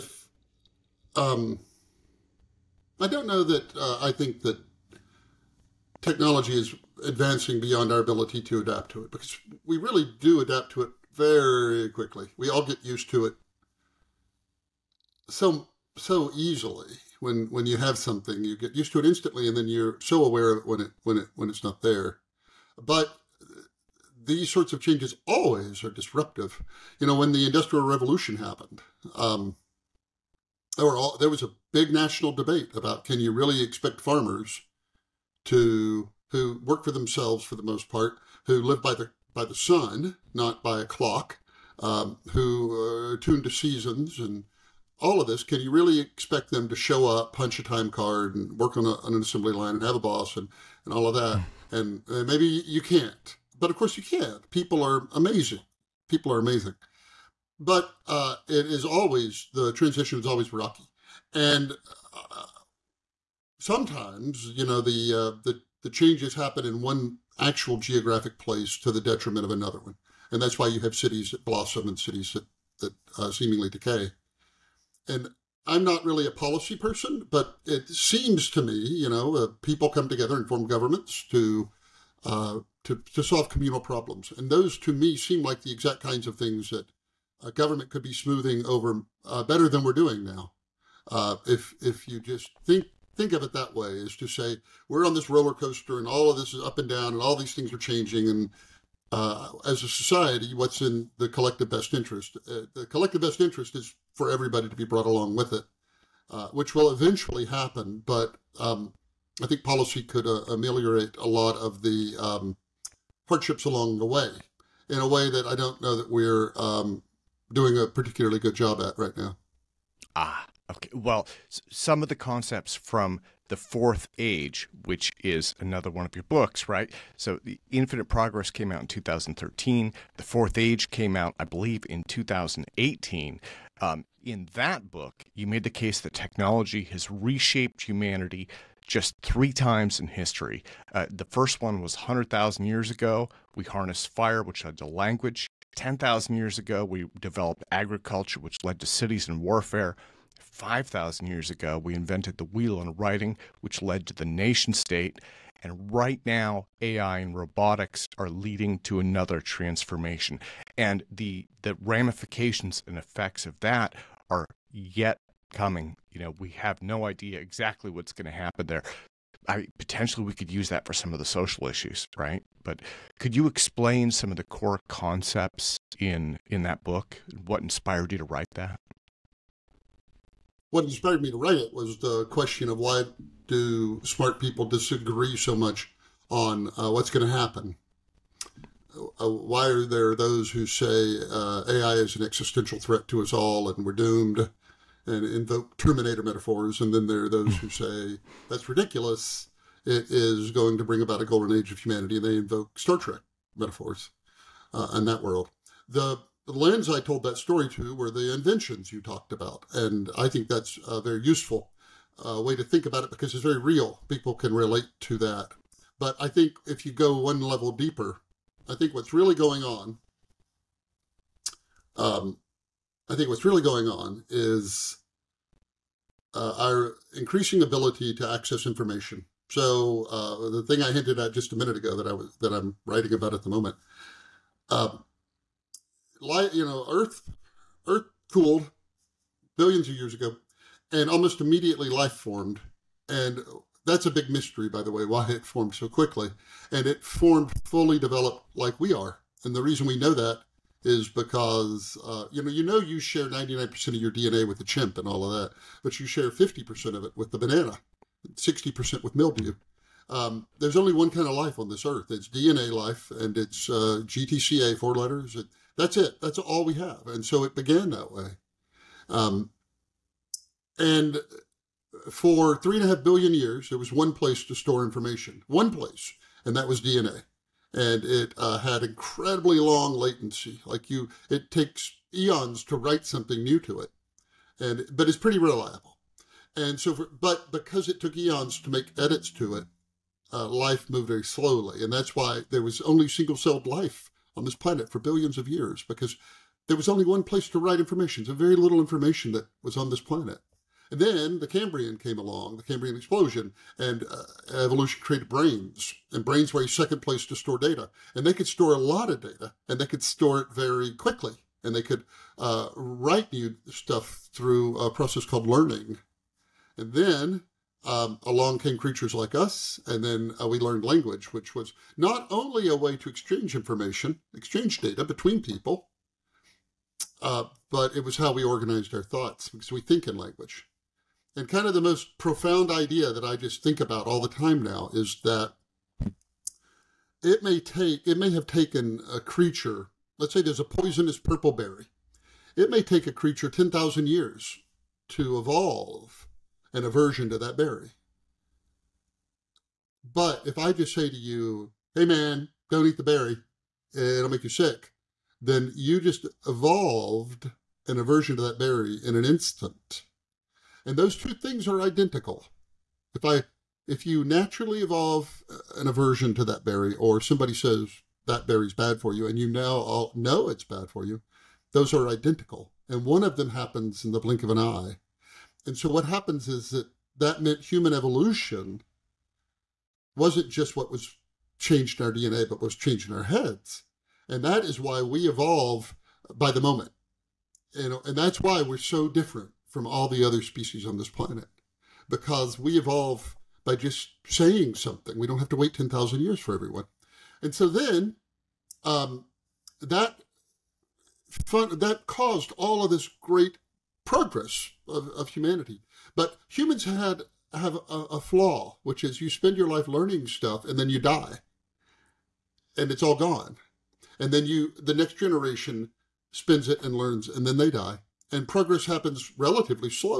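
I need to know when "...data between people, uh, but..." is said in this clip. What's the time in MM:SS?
05:24.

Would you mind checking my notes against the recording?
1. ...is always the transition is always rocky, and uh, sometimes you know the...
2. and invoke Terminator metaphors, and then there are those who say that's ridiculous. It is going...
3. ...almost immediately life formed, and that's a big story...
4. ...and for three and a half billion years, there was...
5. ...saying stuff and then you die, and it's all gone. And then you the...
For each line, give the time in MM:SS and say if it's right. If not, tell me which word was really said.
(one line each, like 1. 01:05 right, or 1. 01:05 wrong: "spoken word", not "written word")
1. 00:58 right
2. 03:15 right
3. 04:01 wrong: "mystery", not "story"
4. 04:30 right
5. 06:49 wrong: "learning", not "saying".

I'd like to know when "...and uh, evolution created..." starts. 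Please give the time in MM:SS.
05:03.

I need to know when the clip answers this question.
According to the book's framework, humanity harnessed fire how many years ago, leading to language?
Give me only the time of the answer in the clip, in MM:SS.
02:21.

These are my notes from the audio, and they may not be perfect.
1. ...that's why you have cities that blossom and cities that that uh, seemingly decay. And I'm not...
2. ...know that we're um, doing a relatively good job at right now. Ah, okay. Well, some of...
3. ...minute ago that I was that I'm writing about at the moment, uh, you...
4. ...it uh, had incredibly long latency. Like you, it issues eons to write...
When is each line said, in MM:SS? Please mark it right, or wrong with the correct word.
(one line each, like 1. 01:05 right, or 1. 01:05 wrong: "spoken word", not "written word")
1. 01:10 right
2. 01:55 wrong: "particularly", not "relatively"
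3. 03:51 right
4. 04:38 wrong: "takes", not "issues".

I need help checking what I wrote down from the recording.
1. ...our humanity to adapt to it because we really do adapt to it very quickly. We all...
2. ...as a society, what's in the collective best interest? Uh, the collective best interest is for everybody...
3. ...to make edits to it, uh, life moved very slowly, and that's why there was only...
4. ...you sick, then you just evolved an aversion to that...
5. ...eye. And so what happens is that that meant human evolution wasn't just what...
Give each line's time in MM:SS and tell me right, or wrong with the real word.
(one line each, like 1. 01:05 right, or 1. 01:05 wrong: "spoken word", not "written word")
1. 00:07 wrong: "ability", not "humanity"
2. 01:39 right
3. 04:48 right
4. 05:54 right
5. 06:14 right.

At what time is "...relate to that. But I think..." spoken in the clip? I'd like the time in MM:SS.
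03:34.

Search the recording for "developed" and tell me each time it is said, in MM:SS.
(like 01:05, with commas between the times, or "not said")
02:27, 04:07.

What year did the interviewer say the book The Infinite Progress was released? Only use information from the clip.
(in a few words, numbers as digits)
2013.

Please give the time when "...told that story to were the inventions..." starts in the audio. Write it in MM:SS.
03:26.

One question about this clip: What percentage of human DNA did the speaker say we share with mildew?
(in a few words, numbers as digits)
60%.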